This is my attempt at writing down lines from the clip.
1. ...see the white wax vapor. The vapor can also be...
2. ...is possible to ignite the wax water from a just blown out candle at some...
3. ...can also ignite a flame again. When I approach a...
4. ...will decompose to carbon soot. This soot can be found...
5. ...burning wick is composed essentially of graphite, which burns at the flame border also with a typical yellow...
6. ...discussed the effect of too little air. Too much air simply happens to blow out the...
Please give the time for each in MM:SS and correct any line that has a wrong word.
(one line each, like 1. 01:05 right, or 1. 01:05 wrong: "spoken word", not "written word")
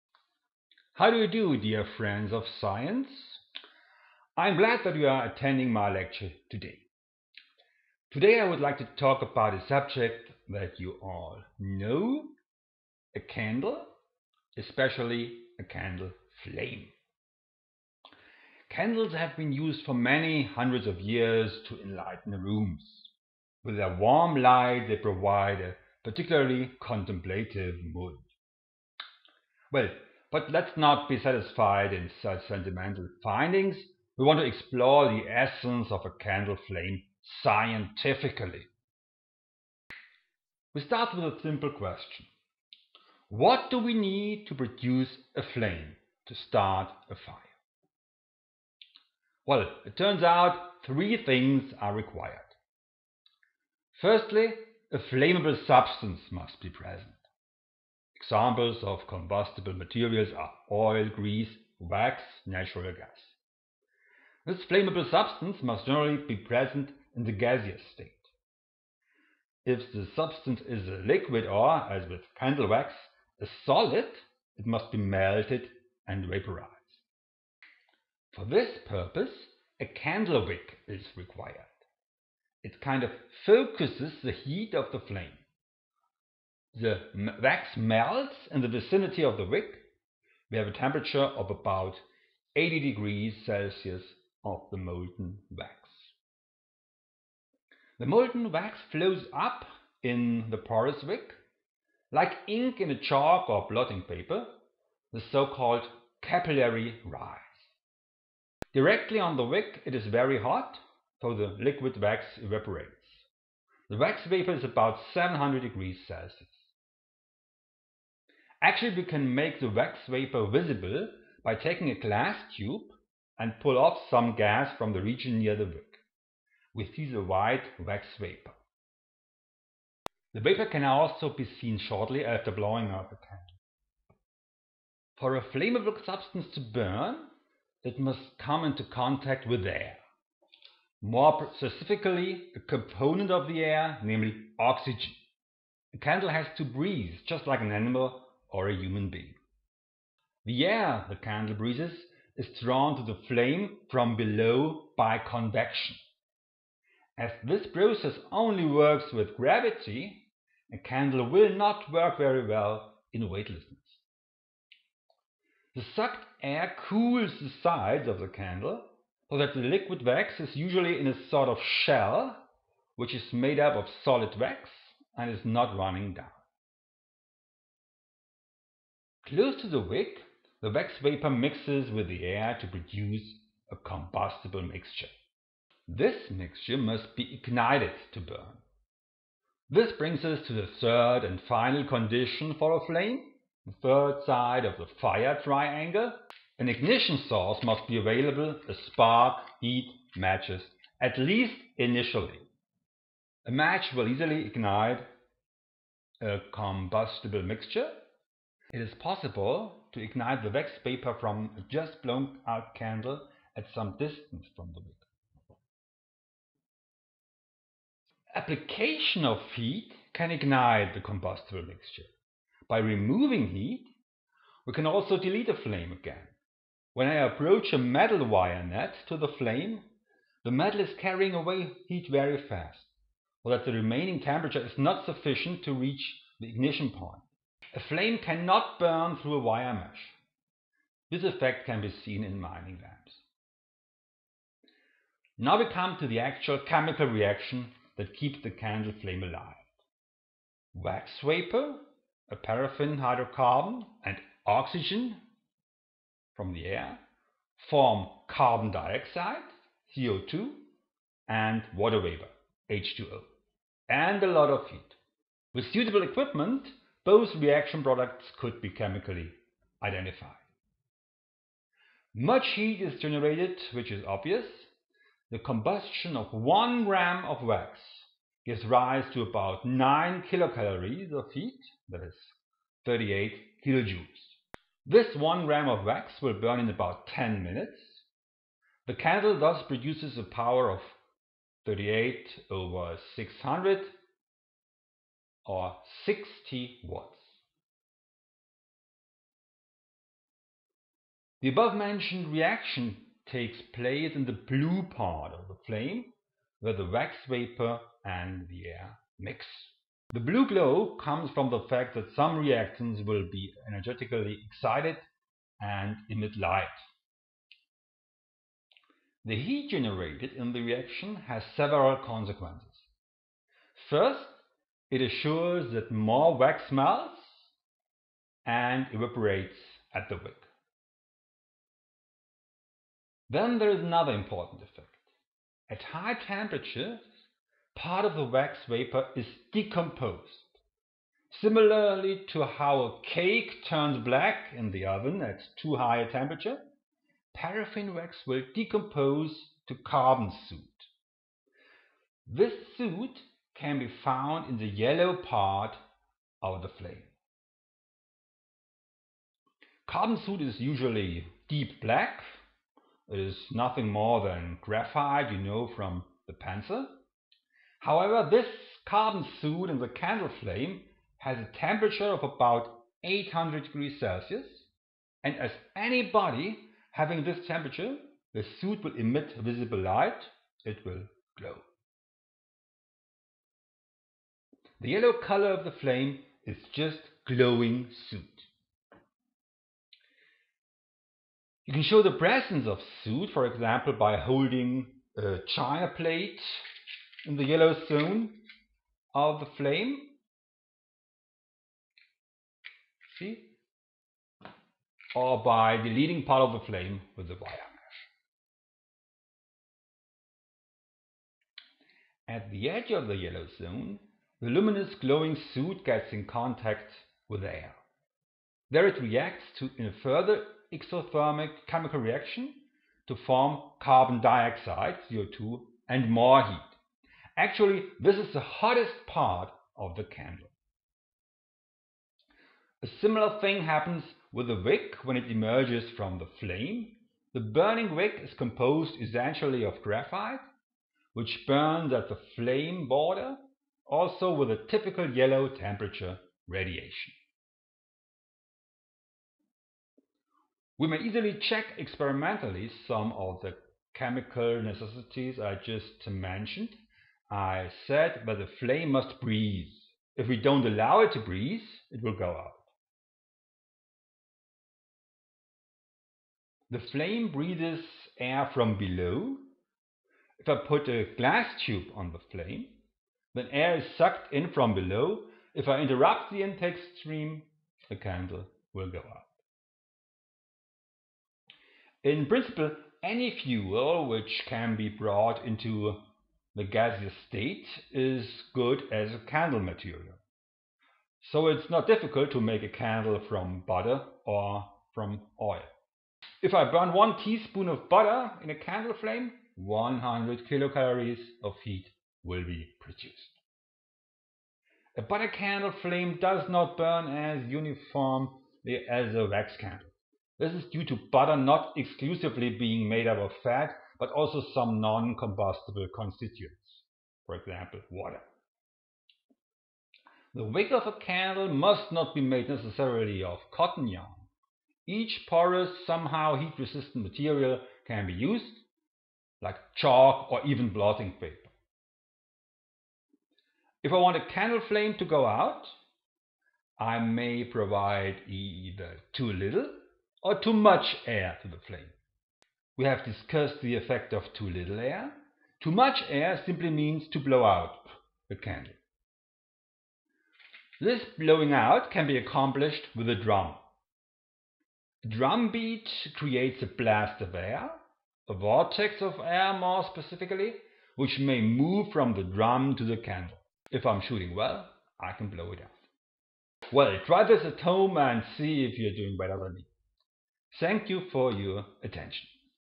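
1. 02:06 right
2. 03:28 wrong: "paper", not "water"
3. 03:44 wrong: "delete", not "ignite"
4. 05:48 right
5. 07:17 right
6. 09:03 wrong: "means", not "happens".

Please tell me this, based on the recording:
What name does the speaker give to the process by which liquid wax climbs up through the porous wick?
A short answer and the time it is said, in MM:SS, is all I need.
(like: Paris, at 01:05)
capillary rise, at 01:46.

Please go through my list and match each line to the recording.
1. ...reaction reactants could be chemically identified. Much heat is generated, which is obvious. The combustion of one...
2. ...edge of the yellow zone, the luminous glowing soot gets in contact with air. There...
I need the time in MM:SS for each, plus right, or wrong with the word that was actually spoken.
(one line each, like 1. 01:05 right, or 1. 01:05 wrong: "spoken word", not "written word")
1. 04:27 wrong: "products", not "reactants"
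2. 06:52 right.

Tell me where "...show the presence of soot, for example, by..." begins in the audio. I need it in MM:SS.
06:31.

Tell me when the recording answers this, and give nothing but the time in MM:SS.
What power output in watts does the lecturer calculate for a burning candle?
04:56.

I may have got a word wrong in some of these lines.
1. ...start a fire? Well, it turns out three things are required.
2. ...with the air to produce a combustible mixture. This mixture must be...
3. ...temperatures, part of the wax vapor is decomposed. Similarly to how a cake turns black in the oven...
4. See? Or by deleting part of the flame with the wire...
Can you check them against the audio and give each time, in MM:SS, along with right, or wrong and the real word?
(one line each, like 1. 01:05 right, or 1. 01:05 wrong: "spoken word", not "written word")
1. 00:46 right
2. 03:01 right
3. 05:36 right
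4. 06:43 right.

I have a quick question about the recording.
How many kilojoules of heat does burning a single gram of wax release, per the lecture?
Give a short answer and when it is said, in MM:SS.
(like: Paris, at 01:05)
38 kilojoules, at 04:42.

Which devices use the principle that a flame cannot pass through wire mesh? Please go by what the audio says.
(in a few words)
mining lamps.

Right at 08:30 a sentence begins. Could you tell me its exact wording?
This is due to butter not exclusively being made up of fat, but also some non-combustible constituents, for example, water.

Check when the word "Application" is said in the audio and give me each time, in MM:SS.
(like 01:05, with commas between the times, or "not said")
03:38.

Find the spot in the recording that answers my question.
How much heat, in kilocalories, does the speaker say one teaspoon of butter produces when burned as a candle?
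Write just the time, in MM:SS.
08:19.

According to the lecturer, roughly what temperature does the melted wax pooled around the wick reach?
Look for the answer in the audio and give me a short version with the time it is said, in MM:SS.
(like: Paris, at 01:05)
80 degrees Celsius, at 01:32.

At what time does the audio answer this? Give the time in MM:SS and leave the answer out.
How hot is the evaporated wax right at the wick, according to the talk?
01:55.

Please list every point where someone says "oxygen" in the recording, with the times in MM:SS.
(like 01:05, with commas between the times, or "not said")
02:24, 04:14.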